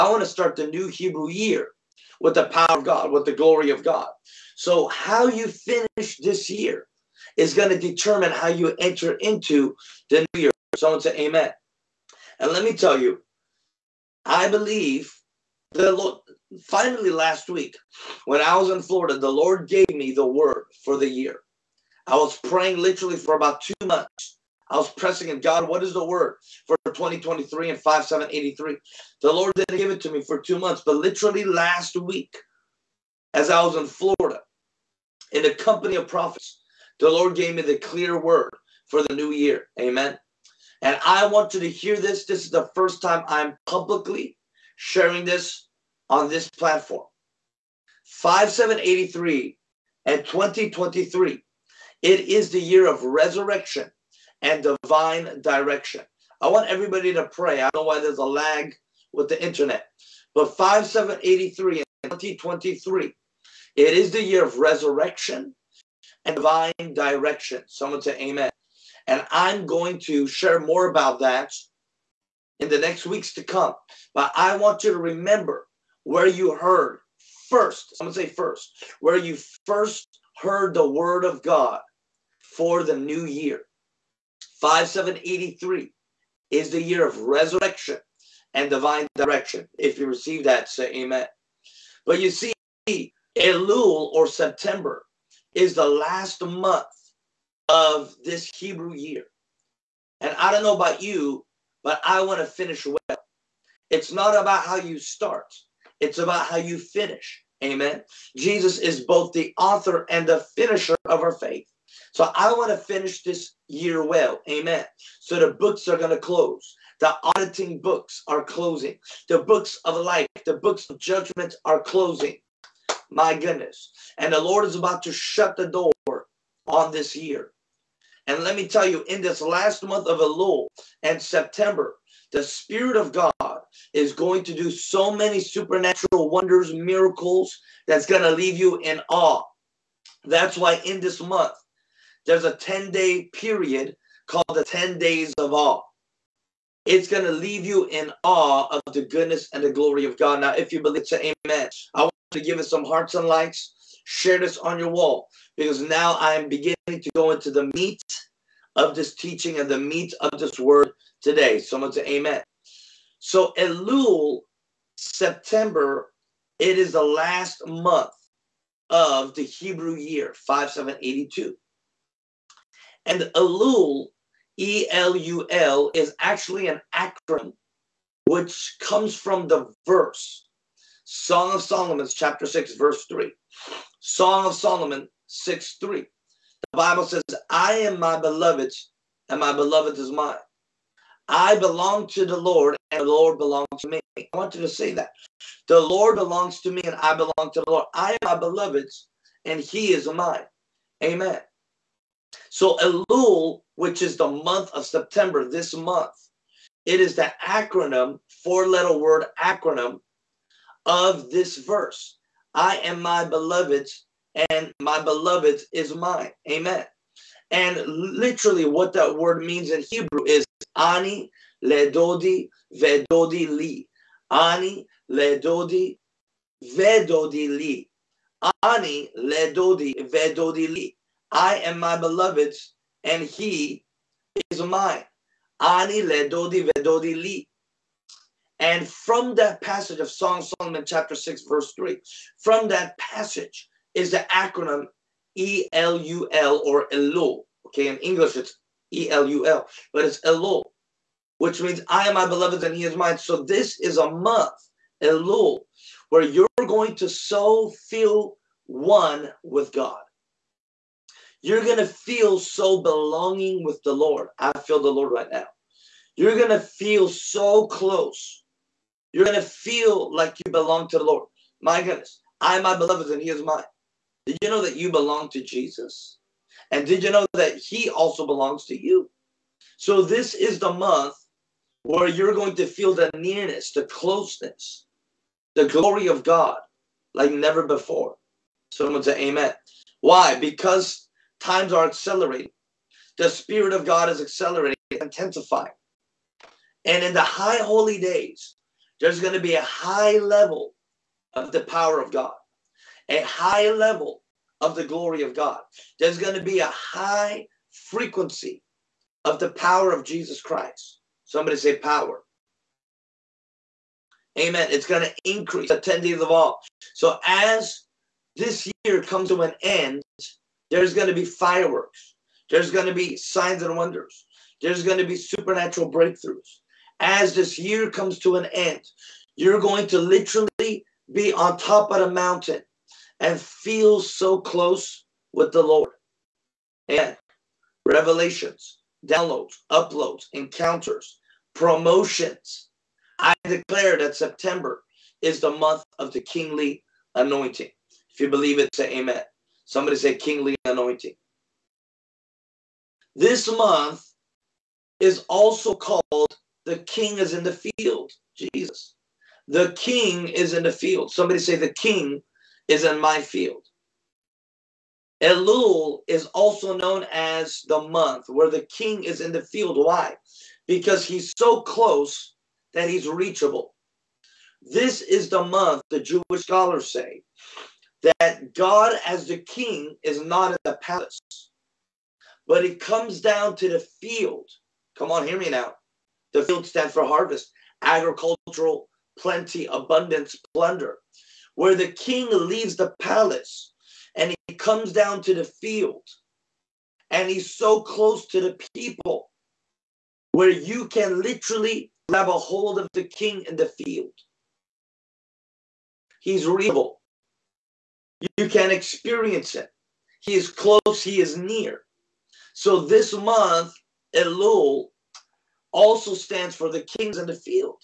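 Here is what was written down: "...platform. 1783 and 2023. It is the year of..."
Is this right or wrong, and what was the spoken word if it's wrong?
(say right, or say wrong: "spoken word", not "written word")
wrong: "5783", not "1783".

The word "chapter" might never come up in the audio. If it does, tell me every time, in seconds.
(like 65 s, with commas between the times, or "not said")
182 s, 240 s.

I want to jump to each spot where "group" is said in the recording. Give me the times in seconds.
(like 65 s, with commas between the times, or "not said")
not said.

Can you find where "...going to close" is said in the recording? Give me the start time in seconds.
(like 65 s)
115 s.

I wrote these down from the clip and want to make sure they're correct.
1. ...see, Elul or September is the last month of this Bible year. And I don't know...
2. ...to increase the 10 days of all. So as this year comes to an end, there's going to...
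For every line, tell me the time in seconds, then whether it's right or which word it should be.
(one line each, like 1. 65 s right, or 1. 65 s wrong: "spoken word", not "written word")
1. 92 s wrong: "Hebrew", not "Bible"
2. 315 s right.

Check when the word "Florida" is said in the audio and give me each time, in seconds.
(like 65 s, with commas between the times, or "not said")
18 s, 33 s.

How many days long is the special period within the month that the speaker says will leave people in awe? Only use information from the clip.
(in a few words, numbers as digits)
10.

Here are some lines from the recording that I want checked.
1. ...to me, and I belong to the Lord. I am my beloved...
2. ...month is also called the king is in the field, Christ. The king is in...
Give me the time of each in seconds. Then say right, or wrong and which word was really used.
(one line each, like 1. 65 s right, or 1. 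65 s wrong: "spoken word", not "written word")
1. 196 s right
2. 353 s wrong: "Jesus", not "Christ".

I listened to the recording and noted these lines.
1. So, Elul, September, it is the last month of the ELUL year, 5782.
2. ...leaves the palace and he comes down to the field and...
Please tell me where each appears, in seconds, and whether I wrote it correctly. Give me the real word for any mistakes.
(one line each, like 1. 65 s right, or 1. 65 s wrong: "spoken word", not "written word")
1. 163 s wrong: "Hebrew", not "ELUL"
2. 392 s right.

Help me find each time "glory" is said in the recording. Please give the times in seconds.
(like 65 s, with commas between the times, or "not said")
3 s, 149 s, 285 s, 304 s.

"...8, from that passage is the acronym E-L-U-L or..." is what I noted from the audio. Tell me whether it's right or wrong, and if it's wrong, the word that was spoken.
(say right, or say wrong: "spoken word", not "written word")
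wrong: "3", not "8".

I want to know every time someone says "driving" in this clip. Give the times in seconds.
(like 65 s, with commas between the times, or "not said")
not said.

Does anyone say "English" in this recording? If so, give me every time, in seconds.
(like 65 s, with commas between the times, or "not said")
247 s.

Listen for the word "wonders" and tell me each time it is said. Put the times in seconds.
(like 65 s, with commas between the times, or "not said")
136 s, 323 s.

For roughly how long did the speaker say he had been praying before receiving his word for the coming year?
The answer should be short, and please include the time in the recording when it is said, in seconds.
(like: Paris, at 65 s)
About two months, at 23 s.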